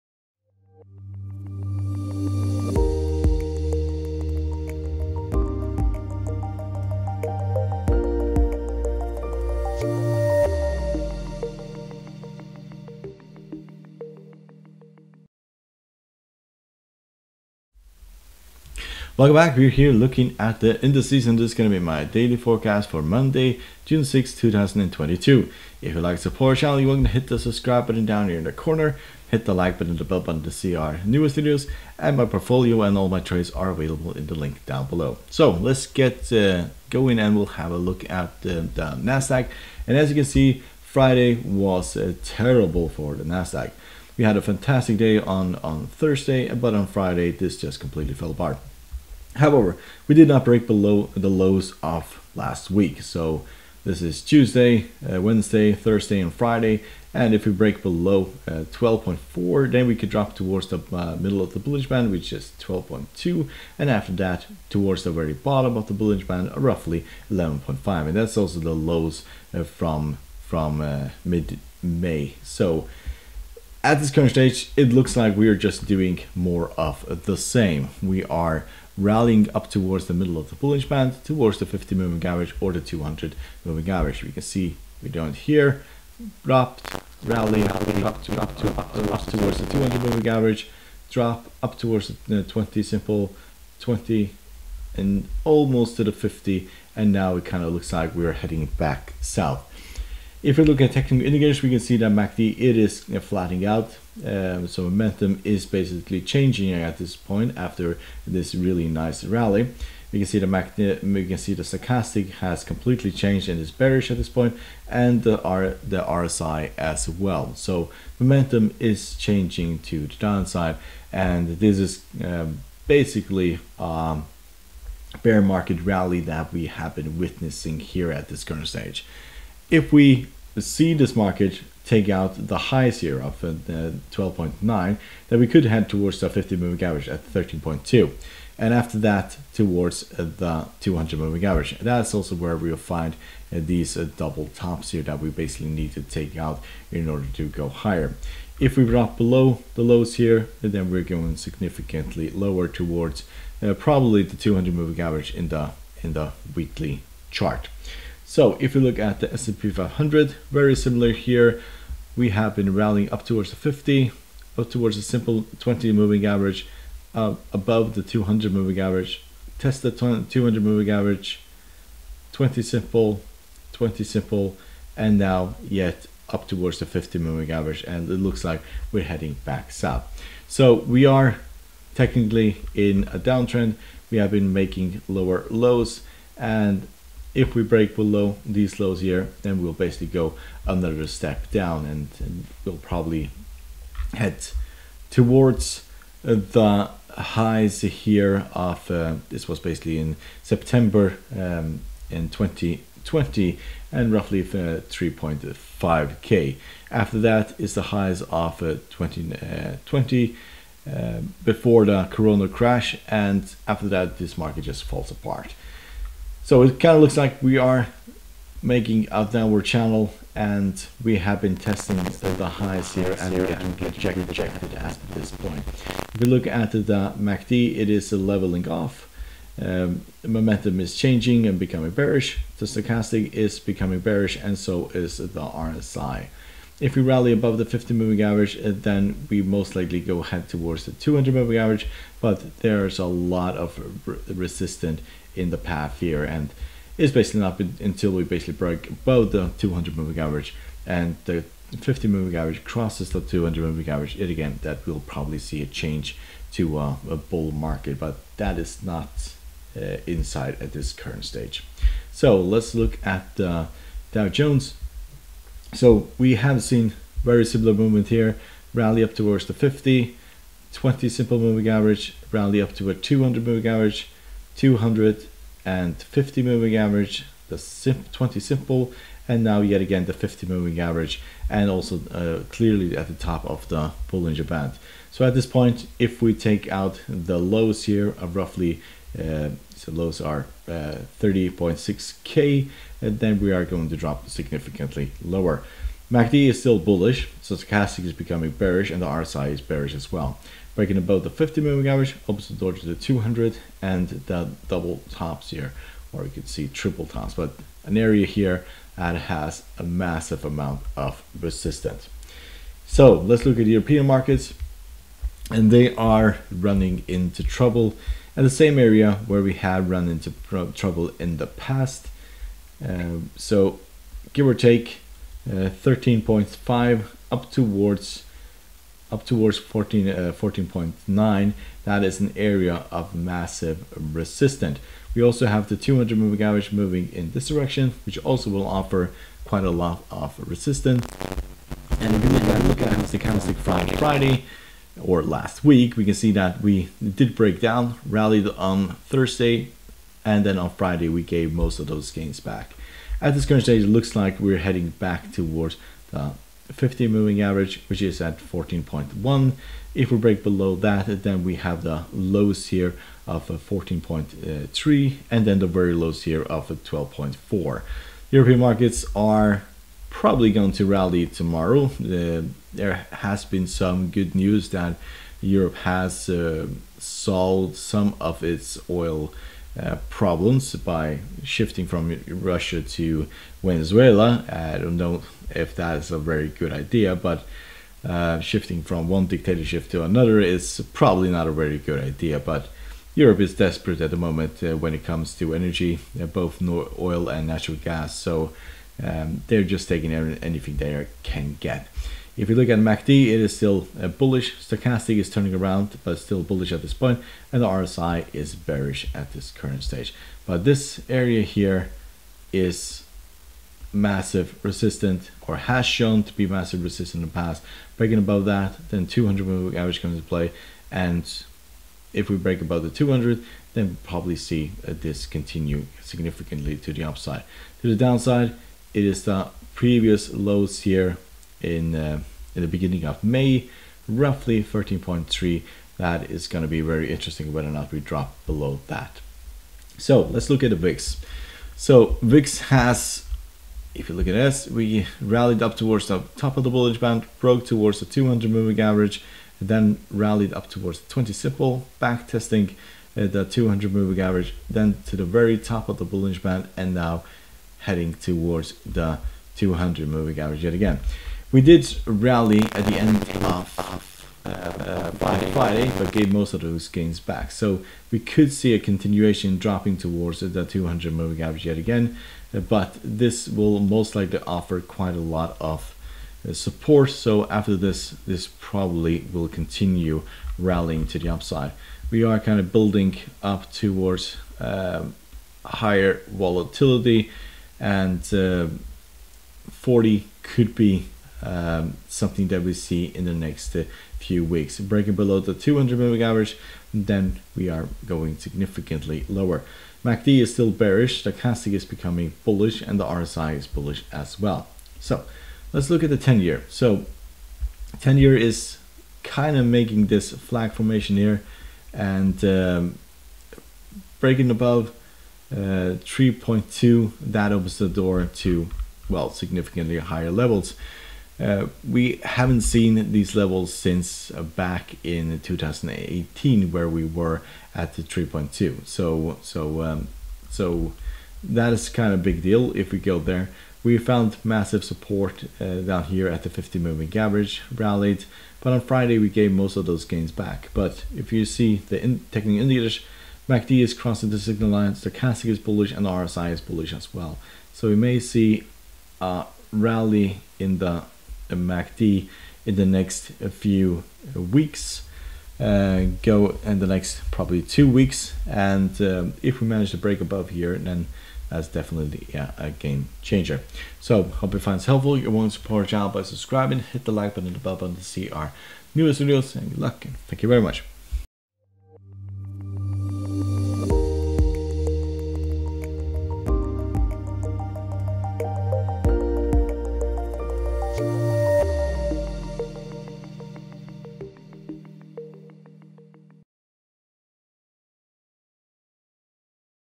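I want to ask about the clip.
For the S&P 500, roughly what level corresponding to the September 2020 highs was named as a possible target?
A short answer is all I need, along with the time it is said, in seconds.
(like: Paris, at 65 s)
3.5k, at 204 s.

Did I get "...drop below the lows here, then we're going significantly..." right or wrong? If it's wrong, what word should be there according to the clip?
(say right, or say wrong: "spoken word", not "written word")
right.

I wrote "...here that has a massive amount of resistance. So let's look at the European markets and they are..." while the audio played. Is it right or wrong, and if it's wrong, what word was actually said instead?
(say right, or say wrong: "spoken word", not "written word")
right.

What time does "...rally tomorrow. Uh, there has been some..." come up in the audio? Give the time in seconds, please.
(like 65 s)
370 s.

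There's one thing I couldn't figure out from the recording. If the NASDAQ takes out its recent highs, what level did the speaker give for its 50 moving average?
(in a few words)
13.2.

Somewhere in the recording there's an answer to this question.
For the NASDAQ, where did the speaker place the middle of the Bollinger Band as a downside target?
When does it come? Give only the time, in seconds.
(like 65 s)
62 s.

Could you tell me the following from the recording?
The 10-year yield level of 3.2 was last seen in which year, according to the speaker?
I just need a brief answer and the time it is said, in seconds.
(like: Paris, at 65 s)
2018, at 525 s.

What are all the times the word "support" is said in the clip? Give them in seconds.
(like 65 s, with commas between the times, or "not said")
26 s, 476 s, 534 s, 565 s.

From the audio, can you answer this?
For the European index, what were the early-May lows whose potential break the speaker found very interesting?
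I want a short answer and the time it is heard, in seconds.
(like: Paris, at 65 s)
13.3, at 434 s.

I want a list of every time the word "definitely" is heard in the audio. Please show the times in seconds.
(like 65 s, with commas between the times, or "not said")
561 s.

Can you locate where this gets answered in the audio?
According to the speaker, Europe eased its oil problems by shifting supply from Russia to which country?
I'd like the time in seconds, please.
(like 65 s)
383 s.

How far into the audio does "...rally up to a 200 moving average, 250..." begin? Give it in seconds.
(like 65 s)
272 s.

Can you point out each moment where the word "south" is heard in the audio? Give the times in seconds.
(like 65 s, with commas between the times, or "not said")
99 s, 179 s.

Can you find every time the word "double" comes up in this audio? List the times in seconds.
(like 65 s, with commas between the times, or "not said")
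143 s, 304 s.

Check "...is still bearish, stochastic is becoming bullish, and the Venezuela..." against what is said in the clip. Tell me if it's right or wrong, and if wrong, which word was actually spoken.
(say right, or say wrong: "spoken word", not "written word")
wrong: "RSI", not "Venezuela".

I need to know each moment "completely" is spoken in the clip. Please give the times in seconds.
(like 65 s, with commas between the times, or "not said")
47 s, 112 s.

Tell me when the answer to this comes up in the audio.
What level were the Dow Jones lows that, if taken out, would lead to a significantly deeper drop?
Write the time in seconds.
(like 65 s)
290 s.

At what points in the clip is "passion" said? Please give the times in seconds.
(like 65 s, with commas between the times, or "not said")
not said.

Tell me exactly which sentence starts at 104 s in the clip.
Um, so momentum is basically changing at this point after this really nice rally.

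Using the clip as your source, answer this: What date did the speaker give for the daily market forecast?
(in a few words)
Monday, June 6, 2022.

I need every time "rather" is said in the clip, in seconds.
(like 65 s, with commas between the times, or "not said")
not said.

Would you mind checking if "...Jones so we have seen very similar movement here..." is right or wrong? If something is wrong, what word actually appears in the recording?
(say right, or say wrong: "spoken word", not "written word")
right.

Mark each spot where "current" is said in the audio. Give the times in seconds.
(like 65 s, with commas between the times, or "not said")
74 s, 128 s, 260 s, 353 s, 409 s.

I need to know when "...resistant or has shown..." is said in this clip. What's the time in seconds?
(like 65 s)
414 s.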